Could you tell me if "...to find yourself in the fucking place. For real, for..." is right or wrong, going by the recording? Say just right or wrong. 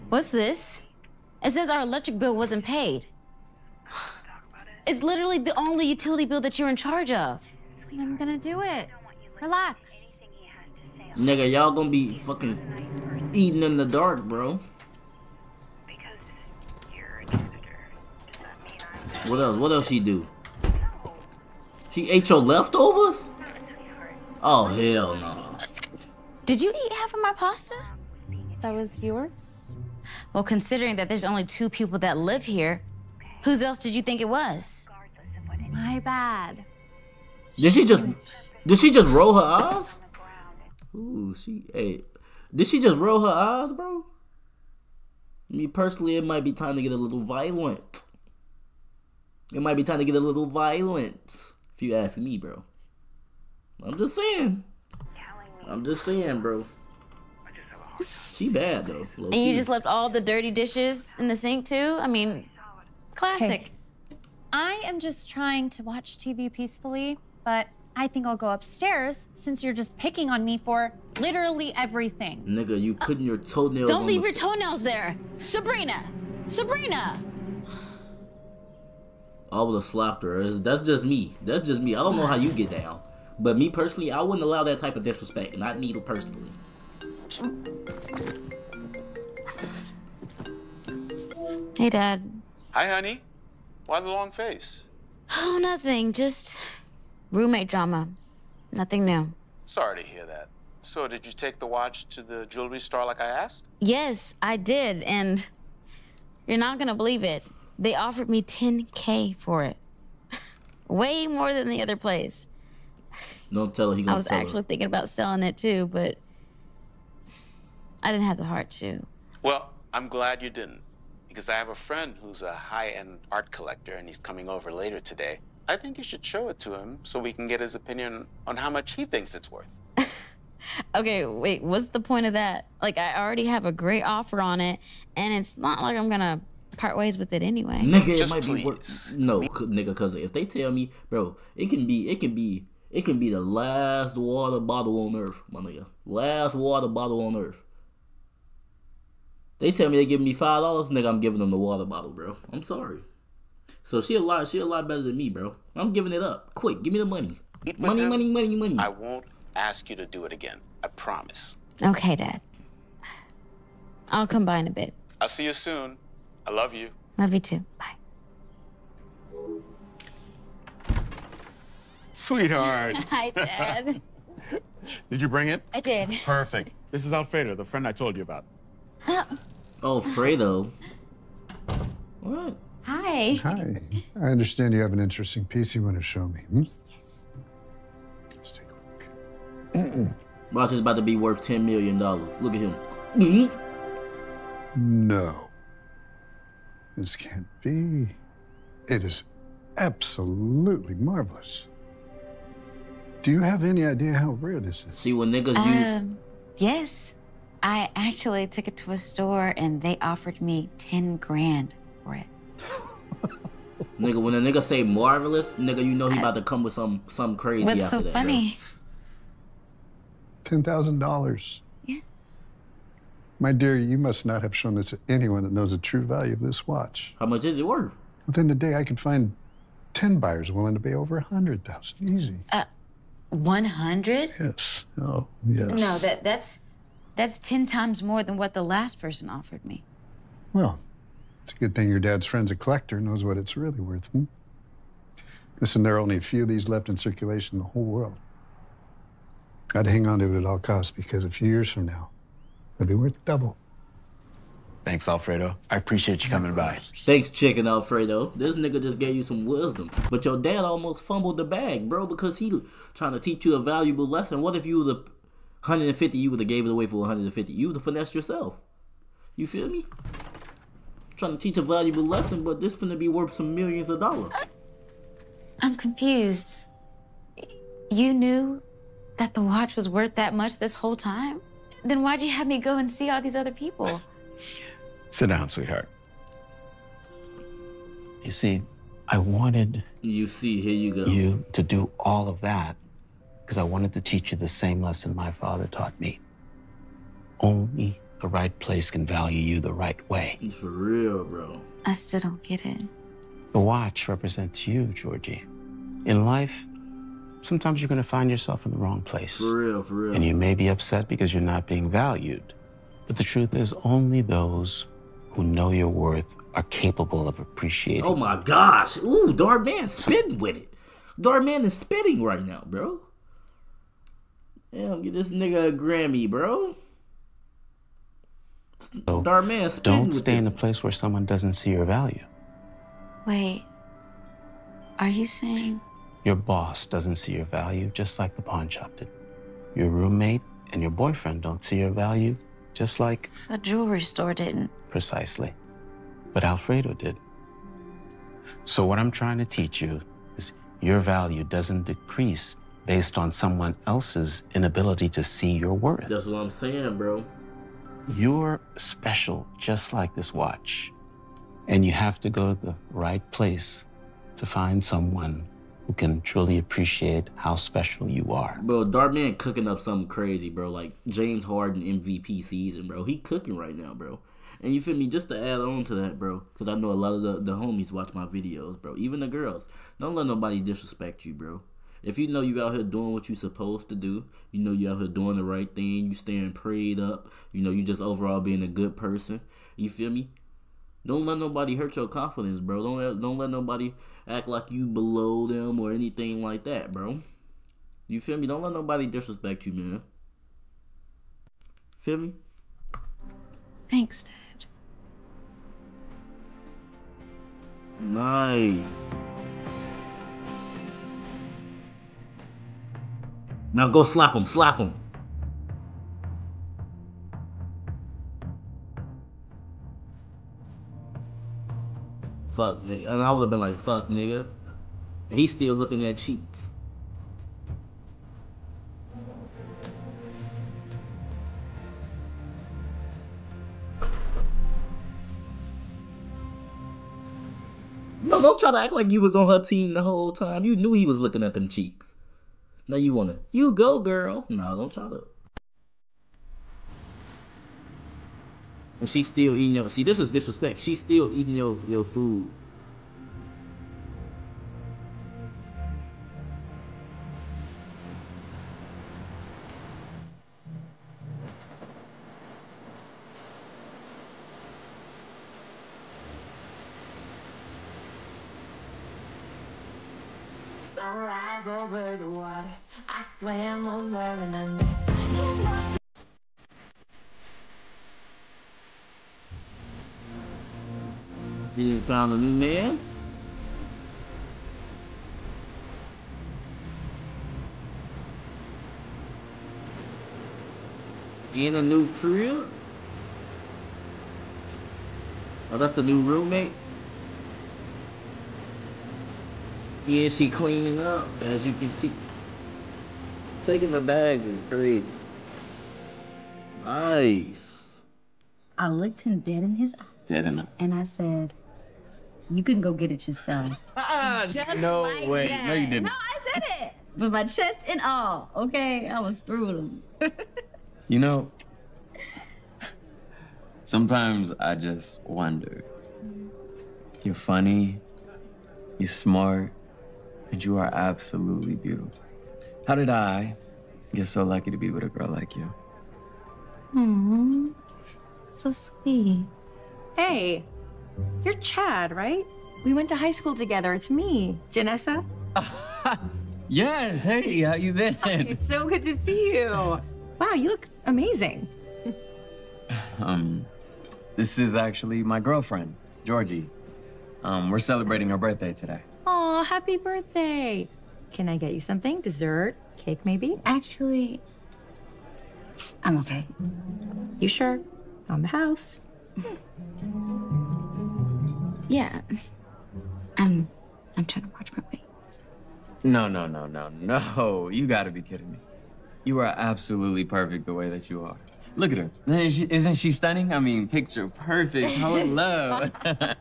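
wrong.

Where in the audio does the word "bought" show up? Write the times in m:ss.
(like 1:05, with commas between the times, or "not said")
not said.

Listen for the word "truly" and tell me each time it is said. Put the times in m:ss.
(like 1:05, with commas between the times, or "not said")
6:06.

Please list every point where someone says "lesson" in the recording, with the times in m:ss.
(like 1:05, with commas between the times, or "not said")
4:24, 4:32, 4:54.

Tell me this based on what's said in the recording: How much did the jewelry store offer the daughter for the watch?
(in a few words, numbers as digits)
10K.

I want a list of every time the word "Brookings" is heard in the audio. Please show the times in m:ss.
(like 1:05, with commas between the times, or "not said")
not said.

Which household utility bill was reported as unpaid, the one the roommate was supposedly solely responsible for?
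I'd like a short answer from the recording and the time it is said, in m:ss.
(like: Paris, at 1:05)
Electric bill, at 0:01.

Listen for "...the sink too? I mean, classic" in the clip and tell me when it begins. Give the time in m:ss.
1:01.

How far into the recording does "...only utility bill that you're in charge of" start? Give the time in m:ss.
0:05.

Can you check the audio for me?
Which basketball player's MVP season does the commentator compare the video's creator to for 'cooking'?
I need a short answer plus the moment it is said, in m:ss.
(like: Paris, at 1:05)
James Harden, at 6:11.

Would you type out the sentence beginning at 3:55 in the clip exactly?
No, that, that's, that's 10 times more than what the last person offered me.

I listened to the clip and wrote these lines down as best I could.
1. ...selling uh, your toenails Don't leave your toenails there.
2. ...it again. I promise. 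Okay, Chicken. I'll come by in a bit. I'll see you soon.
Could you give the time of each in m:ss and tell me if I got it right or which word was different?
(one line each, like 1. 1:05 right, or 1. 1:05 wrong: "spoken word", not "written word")
1. 1:12 wrong: "putting", not "selling"
2. 2:40 wrong: "Dad", not "Chicken".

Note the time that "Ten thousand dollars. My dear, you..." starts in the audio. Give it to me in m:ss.
3:40.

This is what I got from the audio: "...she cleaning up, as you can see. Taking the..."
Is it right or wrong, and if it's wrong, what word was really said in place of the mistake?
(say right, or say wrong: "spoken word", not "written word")
right.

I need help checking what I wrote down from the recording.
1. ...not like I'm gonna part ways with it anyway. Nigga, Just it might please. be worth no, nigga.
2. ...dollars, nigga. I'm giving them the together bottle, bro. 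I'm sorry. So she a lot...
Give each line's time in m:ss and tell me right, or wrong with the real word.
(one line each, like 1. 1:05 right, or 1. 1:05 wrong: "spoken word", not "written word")
1. 2:15 right
2. 2:30 wrong: "water", not "together".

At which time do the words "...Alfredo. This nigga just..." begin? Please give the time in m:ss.
4:17.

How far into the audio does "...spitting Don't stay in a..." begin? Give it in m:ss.
5:29.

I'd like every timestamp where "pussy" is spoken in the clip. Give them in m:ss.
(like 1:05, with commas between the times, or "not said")
not said.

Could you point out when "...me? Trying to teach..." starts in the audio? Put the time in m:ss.
4:29.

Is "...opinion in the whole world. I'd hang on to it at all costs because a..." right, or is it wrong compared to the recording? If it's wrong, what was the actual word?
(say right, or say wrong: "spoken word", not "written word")
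wrong: "circulation", not "opinion".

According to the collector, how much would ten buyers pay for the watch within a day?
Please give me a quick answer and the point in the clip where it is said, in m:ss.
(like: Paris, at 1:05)
Over 100,000, at 3:50.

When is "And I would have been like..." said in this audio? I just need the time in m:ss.
7:03.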